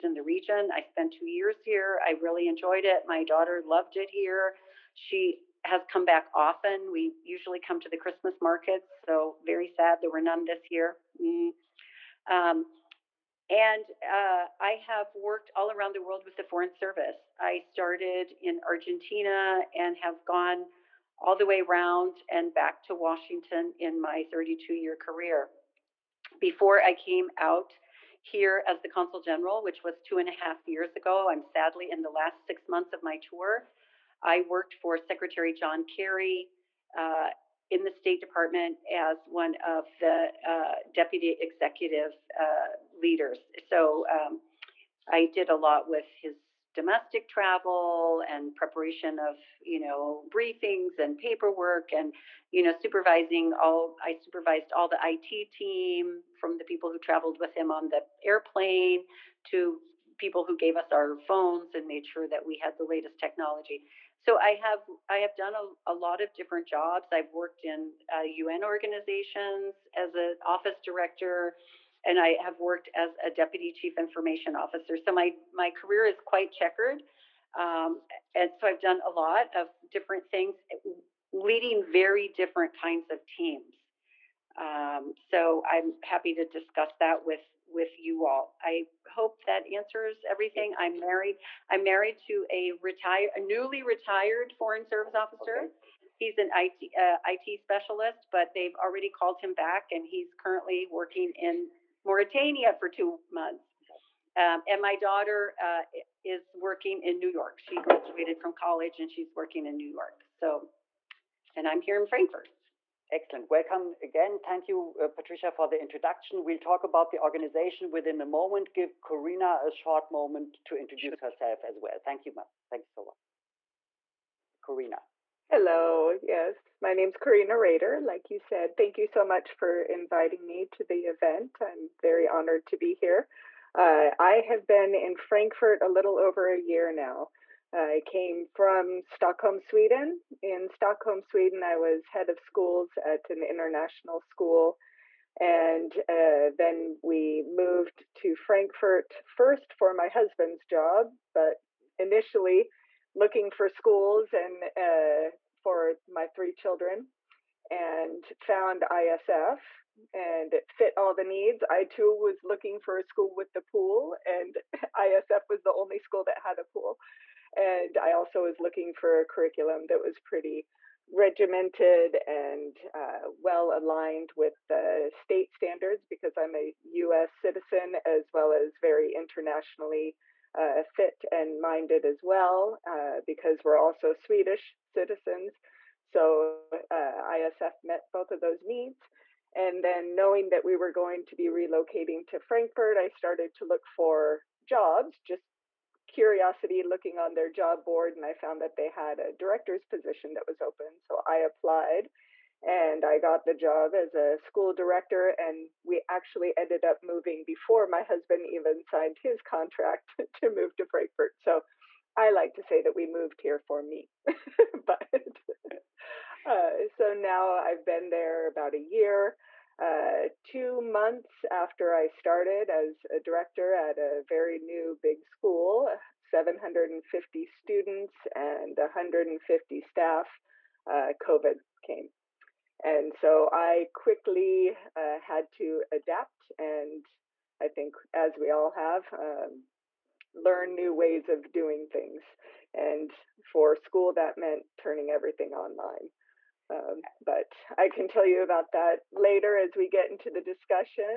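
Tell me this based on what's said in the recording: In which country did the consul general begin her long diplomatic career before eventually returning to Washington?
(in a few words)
Argentina.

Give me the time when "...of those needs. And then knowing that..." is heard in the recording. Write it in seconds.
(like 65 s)
188 s.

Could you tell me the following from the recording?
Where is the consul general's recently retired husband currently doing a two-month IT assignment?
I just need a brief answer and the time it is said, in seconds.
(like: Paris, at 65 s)
Mauritania, at 102 s.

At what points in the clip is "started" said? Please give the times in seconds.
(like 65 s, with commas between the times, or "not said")
17 s, 193 s, 222 s.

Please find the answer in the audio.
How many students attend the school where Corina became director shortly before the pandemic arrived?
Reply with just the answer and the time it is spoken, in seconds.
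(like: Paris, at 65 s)
750, at 226 s.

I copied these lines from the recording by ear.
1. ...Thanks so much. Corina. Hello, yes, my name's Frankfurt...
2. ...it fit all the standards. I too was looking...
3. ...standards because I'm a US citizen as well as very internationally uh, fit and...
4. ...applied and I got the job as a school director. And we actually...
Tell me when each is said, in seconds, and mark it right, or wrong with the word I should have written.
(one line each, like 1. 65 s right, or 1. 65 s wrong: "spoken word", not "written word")
1. 122 s wrong: "Corina", not "Frankfurt"
2. 160 s wrong: "needs", not "standards"
3. 175 s right
4. 201 s right.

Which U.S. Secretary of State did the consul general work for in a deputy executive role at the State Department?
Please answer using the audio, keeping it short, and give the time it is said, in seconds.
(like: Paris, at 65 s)
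John Kerry, at 35 s.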